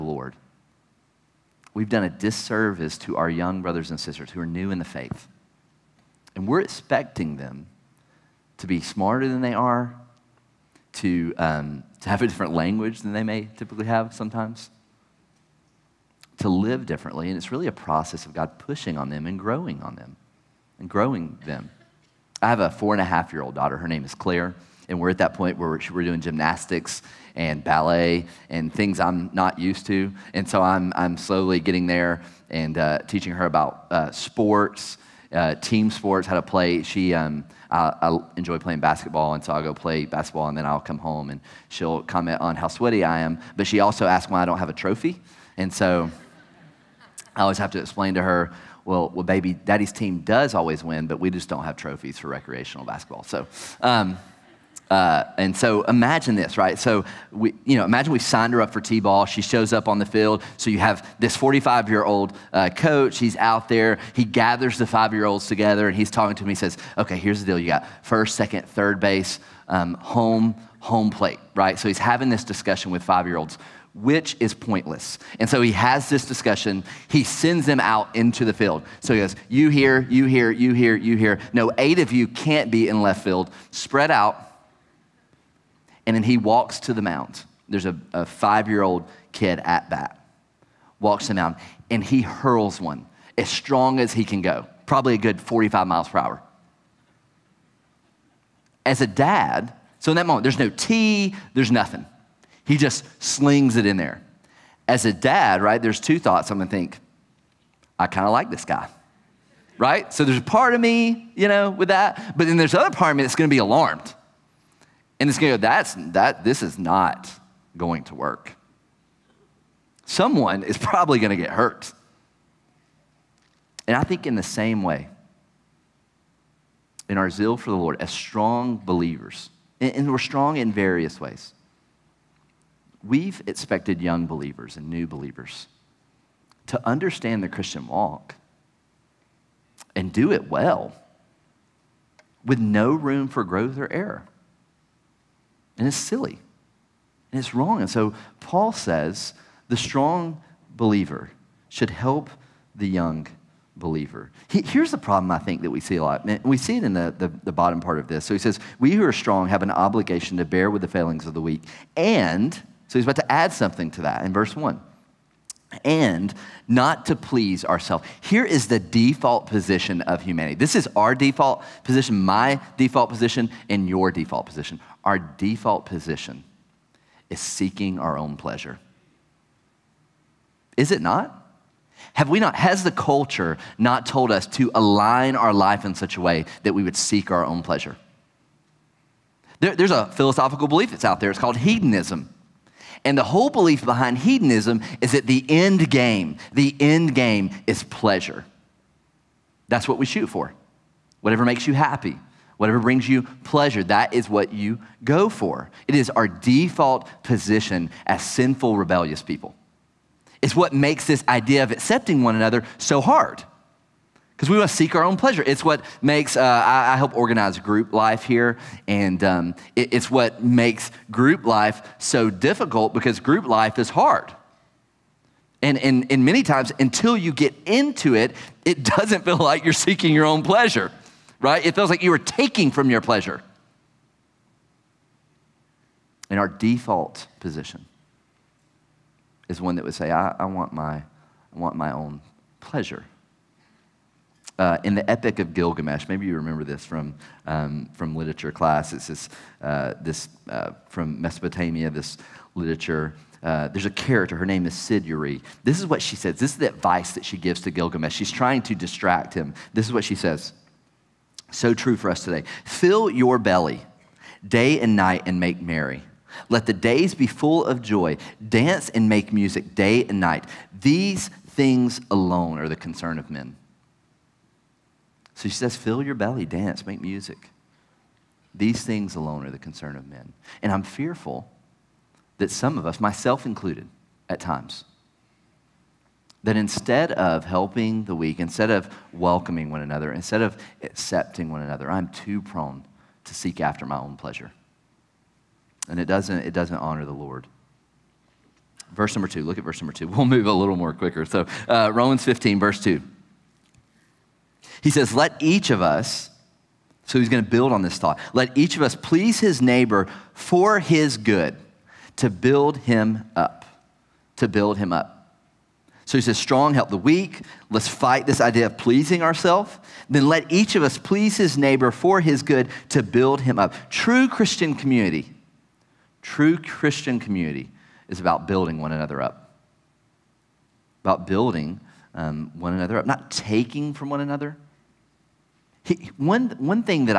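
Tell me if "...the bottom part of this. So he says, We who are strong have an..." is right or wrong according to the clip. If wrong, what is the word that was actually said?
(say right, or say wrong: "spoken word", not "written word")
right.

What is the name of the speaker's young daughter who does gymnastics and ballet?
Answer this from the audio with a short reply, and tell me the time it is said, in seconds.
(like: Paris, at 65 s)
Claire, at 24 s.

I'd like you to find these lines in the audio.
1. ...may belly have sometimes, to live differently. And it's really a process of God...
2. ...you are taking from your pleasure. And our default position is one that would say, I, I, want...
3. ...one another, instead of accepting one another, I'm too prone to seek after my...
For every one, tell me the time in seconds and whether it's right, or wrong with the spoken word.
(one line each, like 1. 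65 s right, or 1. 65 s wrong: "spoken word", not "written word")
1. 13 s wrong: "typically", not "belly"
2. 232 s right
3. 289 s right.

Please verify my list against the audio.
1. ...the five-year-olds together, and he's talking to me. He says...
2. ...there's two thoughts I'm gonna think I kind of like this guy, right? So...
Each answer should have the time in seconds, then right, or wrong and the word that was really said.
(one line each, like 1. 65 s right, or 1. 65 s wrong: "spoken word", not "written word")
1. 64 s right
2. 105 s right.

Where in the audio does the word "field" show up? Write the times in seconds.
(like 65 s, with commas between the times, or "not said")
60 s, 78 s, 83 s.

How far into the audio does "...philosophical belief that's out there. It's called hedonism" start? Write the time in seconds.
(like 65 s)
190 s.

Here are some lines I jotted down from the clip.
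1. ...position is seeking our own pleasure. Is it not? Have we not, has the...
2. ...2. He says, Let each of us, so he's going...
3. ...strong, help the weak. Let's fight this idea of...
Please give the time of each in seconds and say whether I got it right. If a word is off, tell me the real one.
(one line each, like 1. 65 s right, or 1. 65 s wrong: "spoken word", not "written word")
1. 175 s right
2. 302 s right
3. 316 s right.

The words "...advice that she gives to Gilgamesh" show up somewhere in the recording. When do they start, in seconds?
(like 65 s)
256 s.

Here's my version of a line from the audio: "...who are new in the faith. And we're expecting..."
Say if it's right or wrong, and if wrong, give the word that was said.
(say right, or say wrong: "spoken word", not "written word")
right.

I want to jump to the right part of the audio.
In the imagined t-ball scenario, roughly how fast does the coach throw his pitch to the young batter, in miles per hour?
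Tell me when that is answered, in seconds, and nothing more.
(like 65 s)
95 s.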